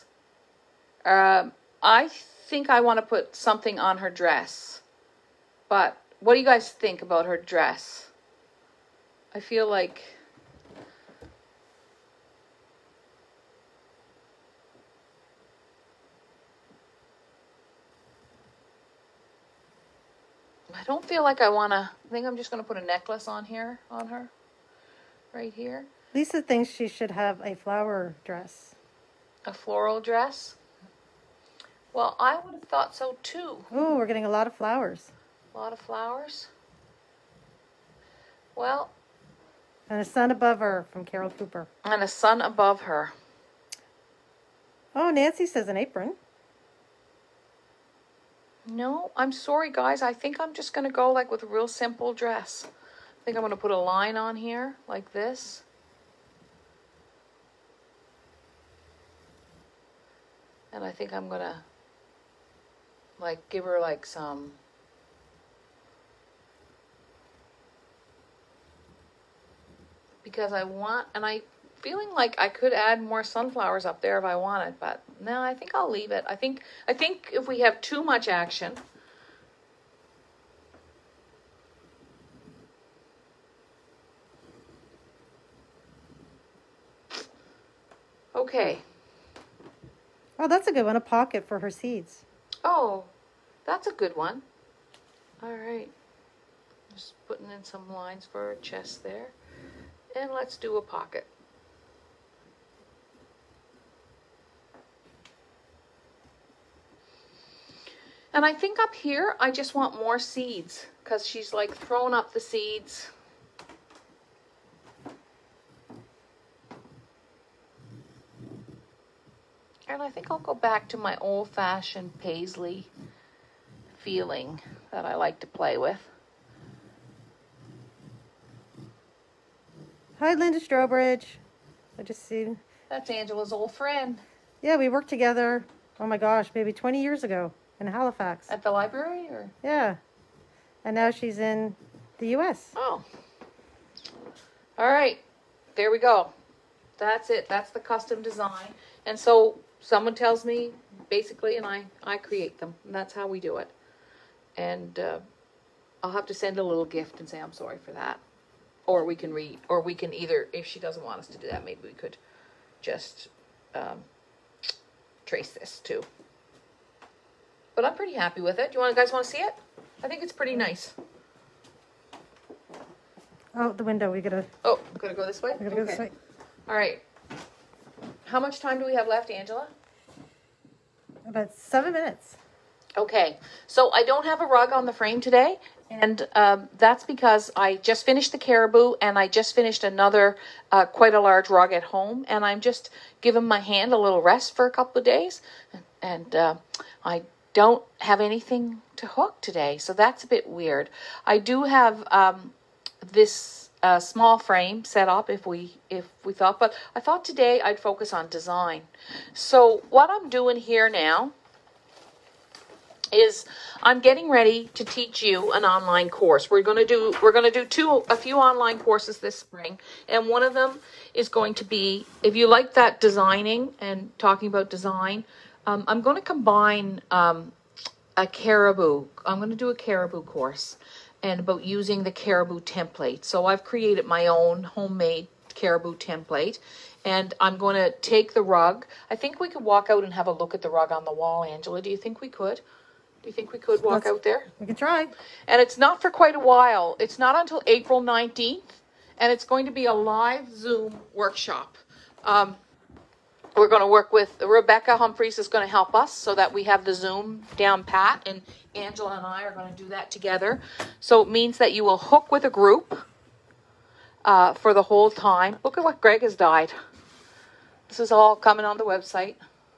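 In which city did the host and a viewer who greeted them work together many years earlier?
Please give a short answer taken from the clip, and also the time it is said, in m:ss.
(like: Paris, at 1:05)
Halifax, at 2:17.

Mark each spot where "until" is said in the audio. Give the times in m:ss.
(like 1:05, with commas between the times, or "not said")
4:07.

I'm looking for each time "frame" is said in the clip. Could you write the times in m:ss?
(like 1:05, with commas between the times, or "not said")
3:04, 3:24.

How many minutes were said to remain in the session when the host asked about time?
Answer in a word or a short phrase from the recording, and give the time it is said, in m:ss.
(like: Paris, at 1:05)
7, at 3:01.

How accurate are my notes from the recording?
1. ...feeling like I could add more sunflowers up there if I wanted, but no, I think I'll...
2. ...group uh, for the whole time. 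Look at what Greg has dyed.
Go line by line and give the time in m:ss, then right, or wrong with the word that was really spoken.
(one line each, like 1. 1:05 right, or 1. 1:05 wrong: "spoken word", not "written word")
1. 1:11 right
2. 4:22 right.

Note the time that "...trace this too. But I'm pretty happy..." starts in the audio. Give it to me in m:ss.
2:45.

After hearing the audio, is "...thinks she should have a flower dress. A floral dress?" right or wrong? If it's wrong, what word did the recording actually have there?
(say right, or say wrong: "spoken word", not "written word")
right.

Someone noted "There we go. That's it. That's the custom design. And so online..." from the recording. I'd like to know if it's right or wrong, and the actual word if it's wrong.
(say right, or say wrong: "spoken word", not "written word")
wrong: "someone", not "online".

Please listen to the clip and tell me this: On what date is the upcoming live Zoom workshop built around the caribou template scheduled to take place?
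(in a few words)
April 19.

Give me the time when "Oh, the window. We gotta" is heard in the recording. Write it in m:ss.
2:53.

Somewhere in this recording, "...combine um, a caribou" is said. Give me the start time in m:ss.
3:46.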